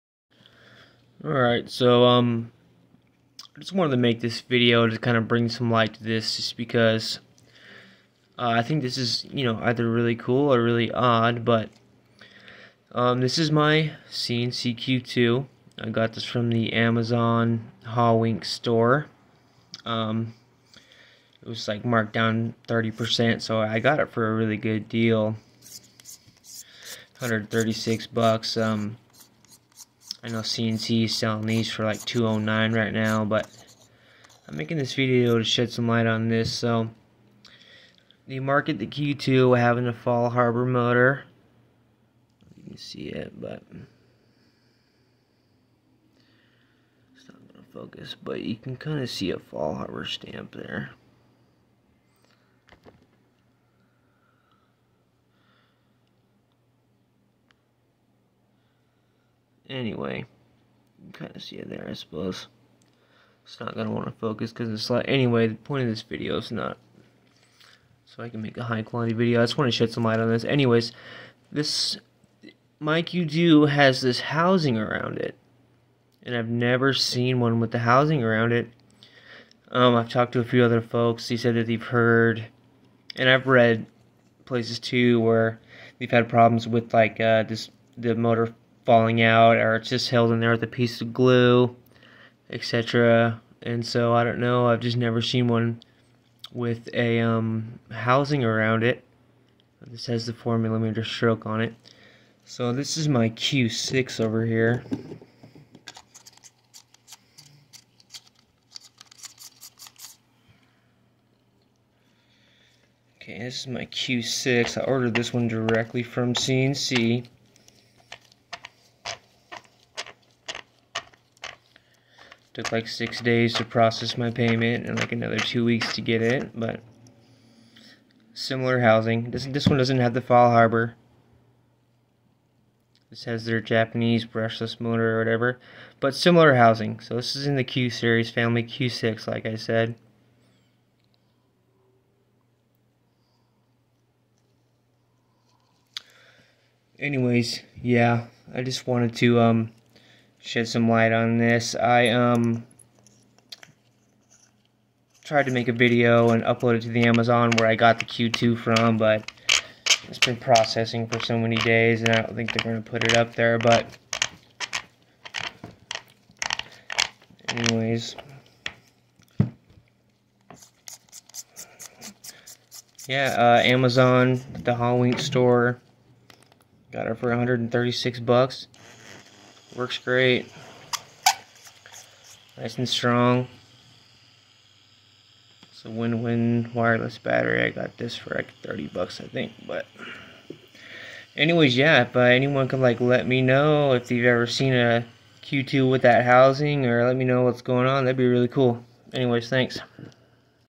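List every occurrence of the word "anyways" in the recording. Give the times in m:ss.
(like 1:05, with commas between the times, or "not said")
0:59, 1:05, 1:10, 2:26, 2:47, 3:11, 3:19.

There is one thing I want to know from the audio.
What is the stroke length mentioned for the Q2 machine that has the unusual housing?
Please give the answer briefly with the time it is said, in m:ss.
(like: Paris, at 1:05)
4 millimeters, at 1:40.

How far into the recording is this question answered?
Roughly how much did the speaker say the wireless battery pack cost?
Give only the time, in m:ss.
3:08.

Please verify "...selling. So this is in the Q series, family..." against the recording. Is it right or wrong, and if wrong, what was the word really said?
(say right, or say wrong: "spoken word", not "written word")
wrong: "housing", not "selling".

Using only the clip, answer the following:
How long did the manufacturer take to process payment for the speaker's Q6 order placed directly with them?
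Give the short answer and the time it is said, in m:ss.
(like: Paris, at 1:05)
6 days, at 2:02.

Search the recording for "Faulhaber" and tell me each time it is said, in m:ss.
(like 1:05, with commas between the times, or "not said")
0:39, 0:49, 2:10.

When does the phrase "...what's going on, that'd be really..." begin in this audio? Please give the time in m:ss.
3:17.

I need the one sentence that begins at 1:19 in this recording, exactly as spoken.
Um, I've talked to a few other folks.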